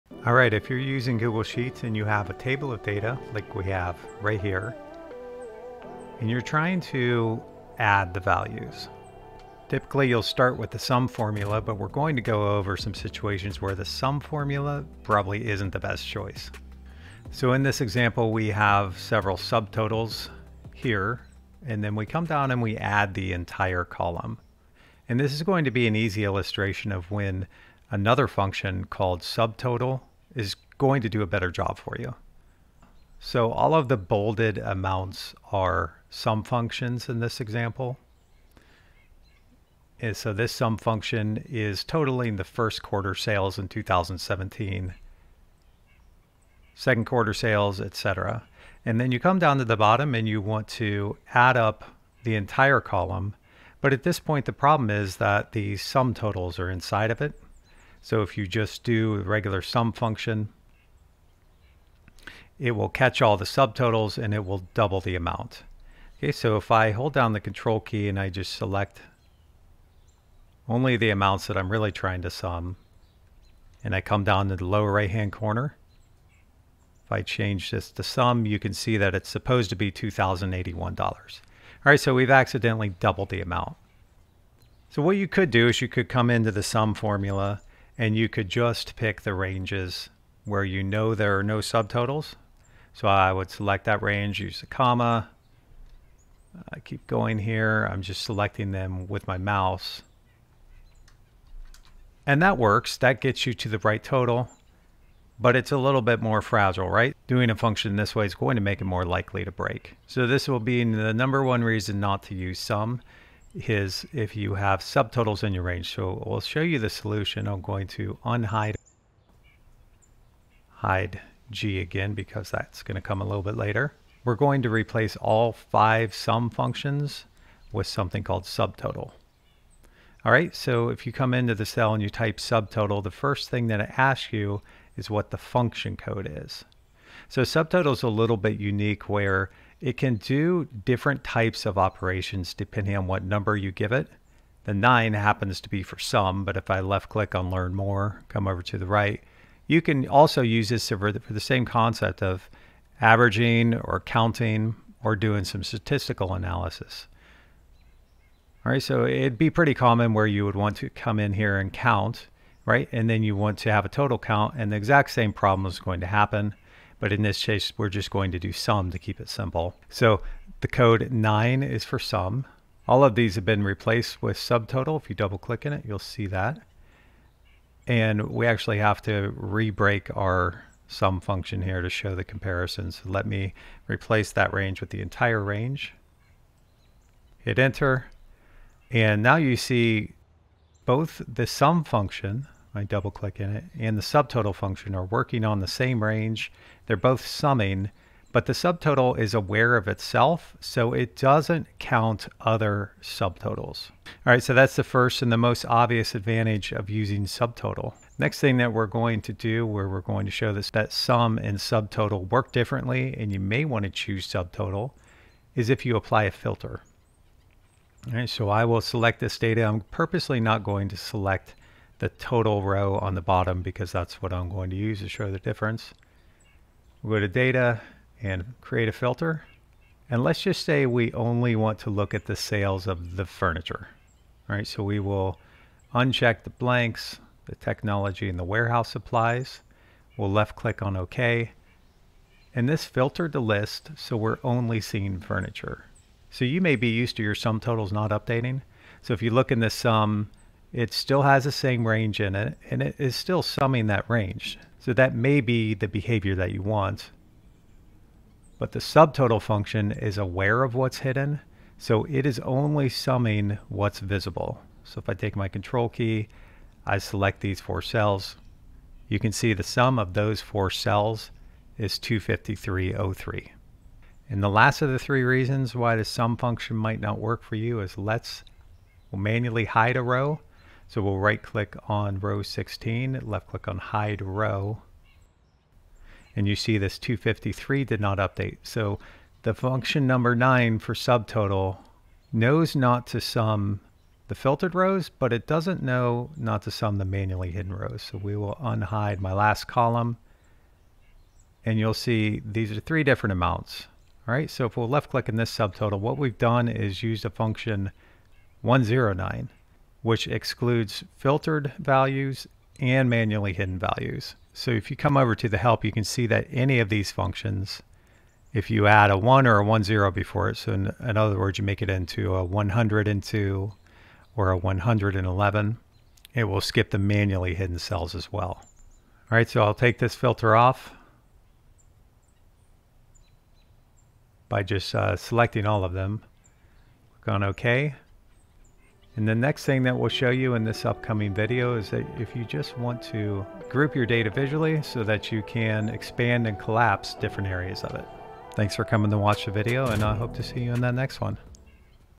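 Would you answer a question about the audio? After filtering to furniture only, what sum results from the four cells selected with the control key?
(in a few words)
253.03.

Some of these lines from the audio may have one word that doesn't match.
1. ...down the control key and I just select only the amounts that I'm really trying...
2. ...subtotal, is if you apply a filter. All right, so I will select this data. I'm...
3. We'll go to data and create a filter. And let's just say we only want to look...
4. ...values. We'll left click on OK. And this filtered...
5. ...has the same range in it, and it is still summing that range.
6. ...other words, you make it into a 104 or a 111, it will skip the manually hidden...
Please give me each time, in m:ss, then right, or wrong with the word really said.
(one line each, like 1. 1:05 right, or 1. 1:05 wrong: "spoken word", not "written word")
1. 1:07 right
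2. 3:34 right
3. 3:47 right
4. 3:58 wrong: "supplies", not "values"
5. 4:11 right
6. 5:21 wrong: "102", not "104".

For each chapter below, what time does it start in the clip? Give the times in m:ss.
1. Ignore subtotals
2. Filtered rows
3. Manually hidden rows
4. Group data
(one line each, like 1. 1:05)
1. 0:17
2. 3:27
3. 4:33
4. 5:38.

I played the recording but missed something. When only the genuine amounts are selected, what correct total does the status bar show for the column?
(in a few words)
$2,081.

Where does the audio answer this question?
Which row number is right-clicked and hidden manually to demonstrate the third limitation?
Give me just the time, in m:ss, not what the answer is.
4:42.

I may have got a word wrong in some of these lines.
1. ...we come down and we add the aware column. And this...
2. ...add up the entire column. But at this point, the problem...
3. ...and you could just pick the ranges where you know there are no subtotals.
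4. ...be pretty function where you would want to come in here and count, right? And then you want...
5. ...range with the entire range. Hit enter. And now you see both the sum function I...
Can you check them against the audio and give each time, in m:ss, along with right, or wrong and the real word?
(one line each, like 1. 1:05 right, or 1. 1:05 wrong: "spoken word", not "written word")
1. 0:21 wrong: "entire", not "aware"
2. 0:51 right
3. 1:28 right
4. 2:39 wrong: "common", not "function"
5. 3:04 right.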